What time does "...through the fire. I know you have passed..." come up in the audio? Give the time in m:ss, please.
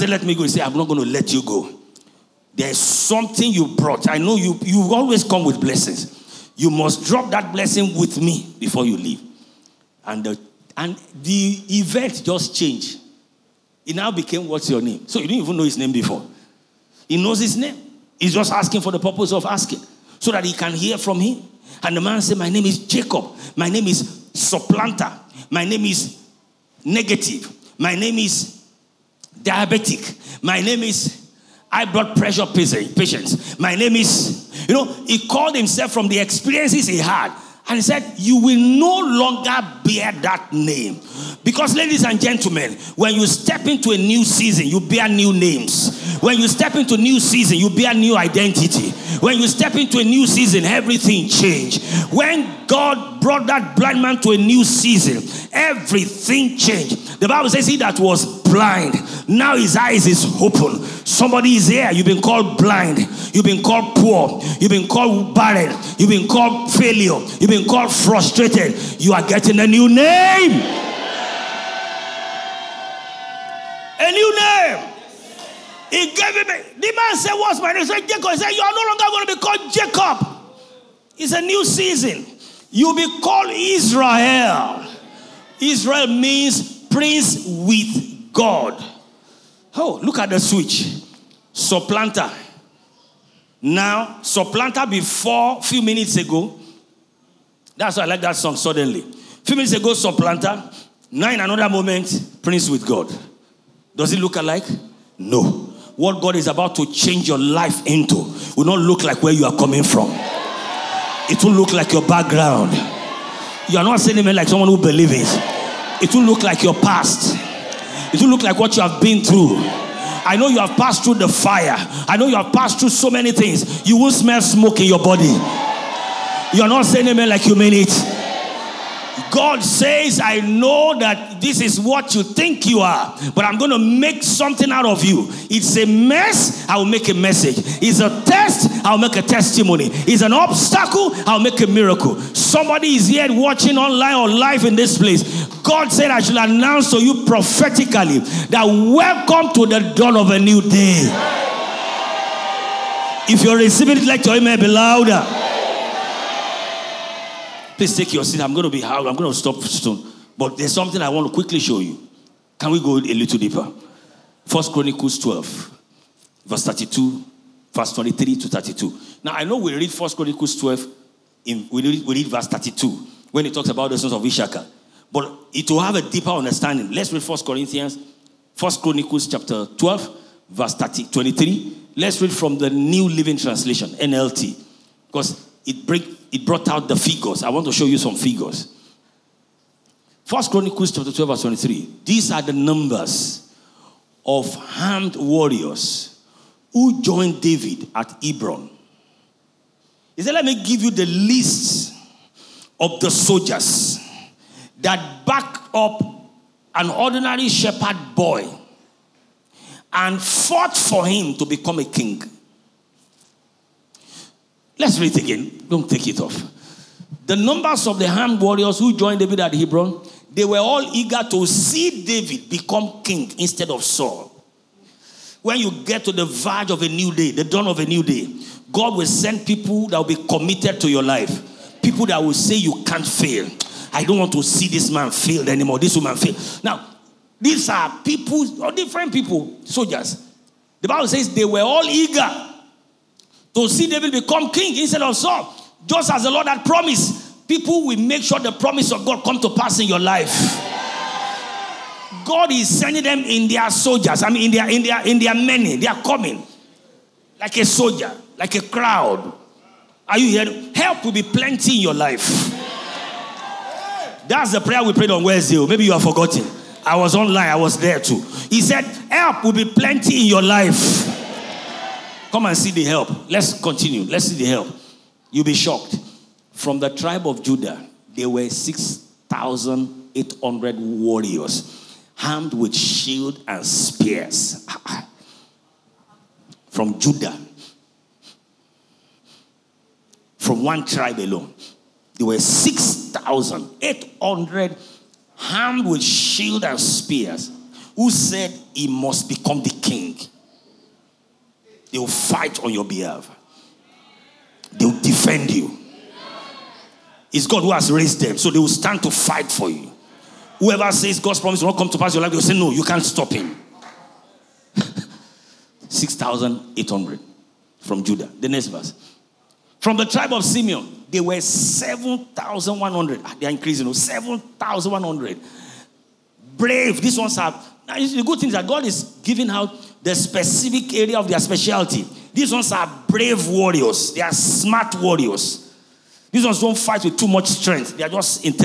2:01.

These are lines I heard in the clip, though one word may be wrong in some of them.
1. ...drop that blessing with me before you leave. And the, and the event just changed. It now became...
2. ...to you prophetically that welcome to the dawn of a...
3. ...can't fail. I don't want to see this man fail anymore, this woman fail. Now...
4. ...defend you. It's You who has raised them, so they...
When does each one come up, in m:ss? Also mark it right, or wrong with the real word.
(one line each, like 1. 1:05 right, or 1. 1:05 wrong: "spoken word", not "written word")
1. 0:07 right
2. 2:26 right
3. 3:52 right
4. 5:05 wrong: "God", not "You".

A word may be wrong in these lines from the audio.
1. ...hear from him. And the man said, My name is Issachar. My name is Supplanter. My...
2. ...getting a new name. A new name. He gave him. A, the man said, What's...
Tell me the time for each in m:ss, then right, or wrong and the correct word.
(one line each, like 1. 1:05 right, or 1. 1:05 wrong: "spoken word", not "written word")
1. 0:20 wrong: "Jacob", not "Issachar"
2. 1:09 right.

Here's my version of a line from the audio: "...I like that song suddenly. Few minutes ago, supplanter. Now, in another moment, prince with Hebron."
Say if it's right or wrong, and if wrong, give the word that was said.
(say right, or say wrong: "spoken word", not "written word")
wrong: "God", not "Hebron".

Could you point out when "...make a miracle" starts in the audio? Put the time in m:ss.
2:21.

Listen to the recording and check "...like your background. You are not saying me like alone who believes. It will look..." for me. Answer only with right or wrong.
wrong.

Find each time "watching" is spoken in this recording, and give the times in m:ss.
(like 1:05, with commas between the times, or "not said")
2:23.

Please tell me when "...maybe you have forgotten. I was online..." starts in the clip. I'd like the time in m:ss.
4:25.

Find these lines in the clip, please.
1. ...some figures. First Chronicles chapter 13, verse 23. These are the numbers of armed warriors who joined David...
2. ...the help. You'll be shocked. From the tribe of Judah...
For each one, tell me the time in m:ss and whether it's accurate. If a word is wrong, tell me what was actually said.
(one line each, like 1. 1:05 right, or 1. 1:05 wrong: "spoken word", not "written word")
1. 3:07 wrong: "12", not "13"
2. 4:34 right.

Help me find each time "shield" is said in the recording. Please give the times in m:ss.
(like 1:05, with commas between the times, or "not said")
4:42, 4:56.